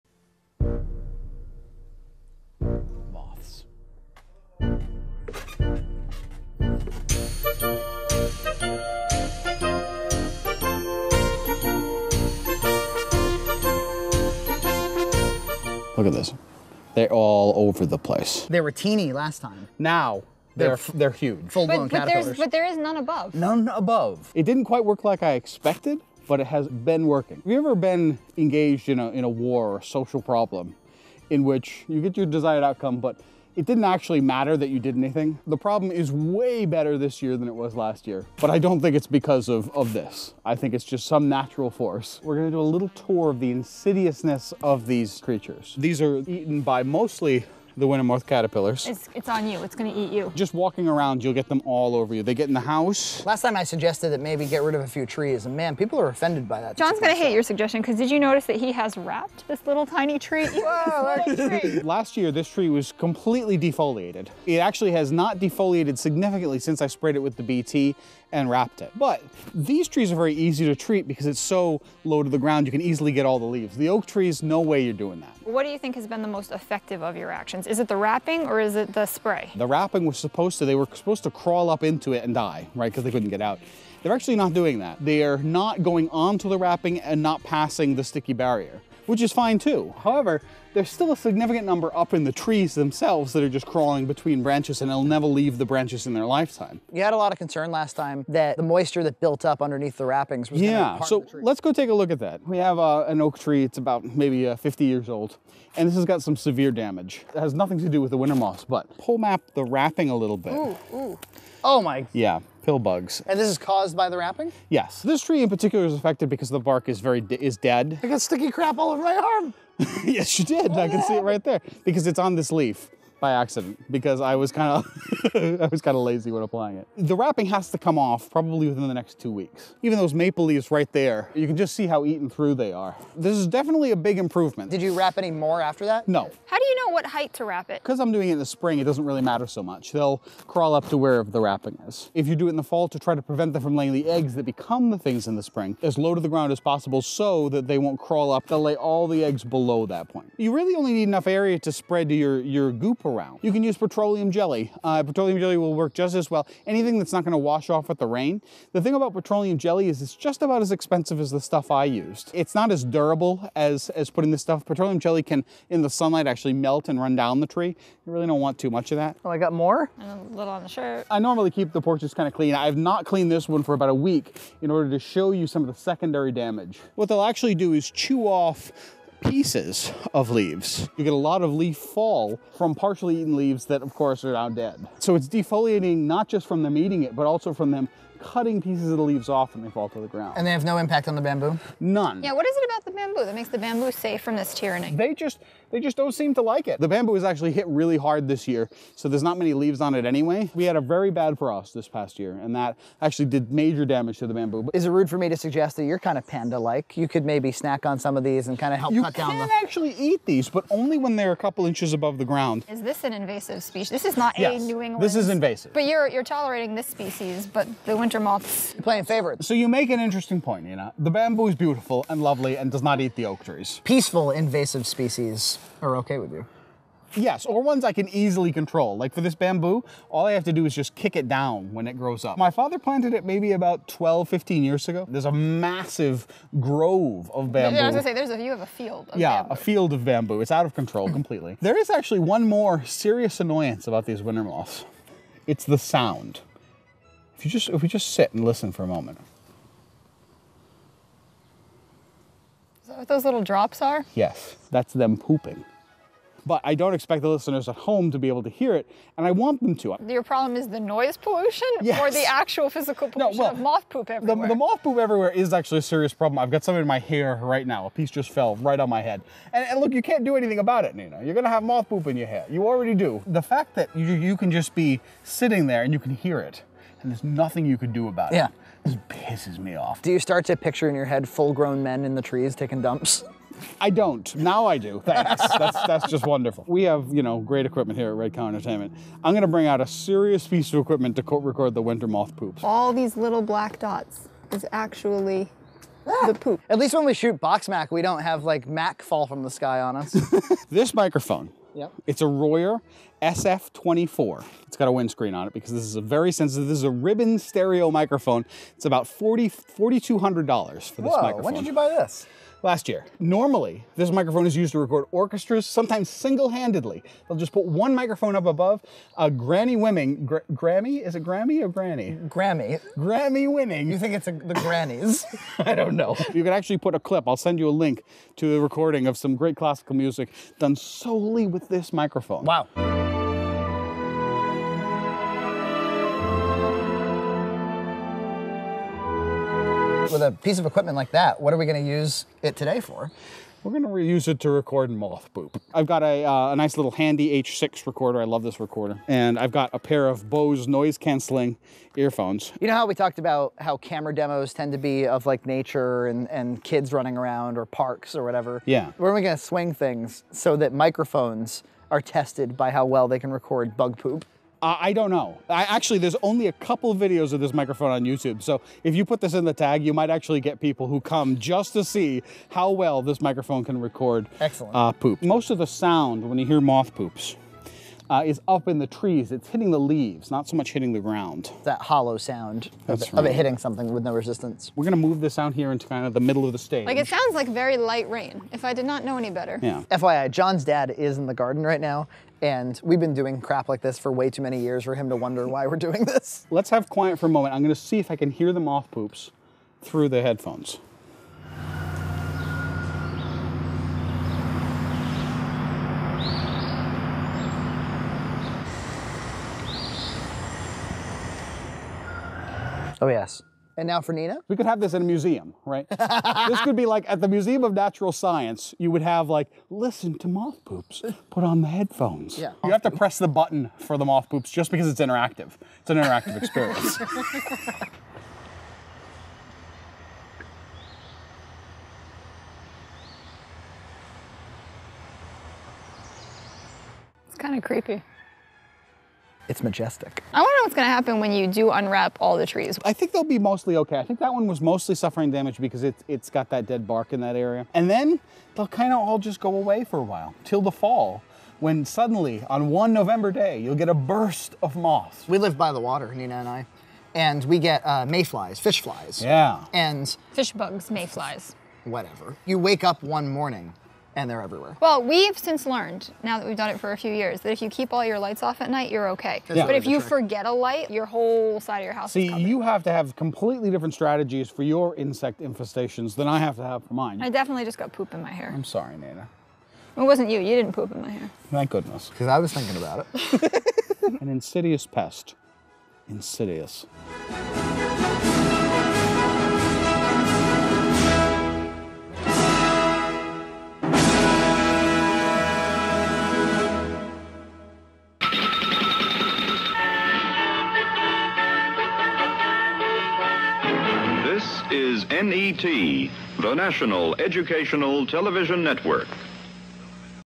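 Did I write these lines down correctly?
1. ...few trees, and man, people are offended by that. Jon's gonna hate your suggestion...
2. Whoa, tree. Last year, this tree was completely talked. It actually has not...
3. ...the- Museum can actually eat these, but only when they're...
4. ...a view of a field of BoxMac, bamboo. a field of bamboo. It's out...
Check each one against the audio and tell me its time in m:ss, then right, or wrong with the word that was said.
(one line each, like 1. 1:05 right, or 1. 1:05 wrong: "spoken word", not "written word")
1. 0:54 right
2. 1:00 wrong: "defoliated", not "talked"
3. 3:29 wrong: "You", not "Museum"
4. 3:58 wrong: "Yeah", not "BoxMac".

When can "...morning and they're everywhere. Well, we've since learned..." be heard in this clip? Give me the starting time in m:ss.
7:43.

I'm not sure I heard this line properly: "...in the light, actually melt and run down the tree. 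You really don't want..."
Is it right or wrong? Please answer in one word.
wrong.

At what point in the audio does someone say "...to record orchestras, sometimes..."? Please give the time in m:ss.
5:14.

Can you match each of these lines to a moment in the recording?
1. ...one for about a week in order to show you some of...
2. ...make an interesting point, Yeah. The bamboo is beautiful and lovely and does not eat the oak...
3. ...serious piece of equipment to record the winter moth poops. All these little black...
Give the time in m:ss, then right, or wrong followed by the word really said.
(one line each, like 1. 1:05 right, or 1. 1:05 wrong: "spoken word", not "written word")
1. 2:53 right
2. 3:39 wrong: "Nina", not "Yeah"
3. 4:49 right.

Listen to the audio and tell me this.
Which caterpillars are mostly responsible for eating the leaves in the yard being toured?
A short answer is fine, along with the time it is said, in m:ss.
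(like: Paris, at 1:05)
Wintermoth caterpillars, at 0:47.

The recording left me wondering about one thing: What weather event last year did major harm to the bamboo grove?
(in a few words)
Frost.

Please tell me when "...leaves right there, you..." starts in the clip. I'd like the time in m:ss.
2:10.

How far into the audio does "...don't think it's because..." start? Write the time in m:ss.
0:38.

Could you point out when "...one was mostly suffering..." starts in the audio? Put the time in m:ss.
7:24.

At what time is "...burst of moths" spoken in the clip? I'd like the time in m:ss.
7:33.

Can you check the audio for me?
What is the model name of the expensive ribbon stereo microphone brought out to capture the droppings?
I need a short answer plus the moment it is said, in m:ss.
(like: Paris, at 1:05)
Royer SF24, at 5:02.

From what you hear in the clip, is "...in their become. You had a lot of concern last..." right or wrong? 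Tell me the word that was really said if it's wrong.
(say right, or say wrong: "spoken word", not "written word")
wrong: "lifetime", not "become".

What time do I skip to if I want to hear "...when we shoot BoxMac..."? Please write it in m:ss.
4:56.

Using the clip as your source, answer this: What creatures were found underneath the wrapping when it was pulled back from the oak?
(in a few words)
Pill bugs.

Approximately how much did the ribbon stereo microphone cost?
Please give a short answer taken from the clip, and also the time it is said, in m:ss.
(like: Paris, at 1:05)
$4,200, at 5:09.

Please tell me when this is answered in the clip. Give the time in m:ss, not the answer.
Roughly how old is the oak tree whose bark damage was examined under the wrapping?
1:44.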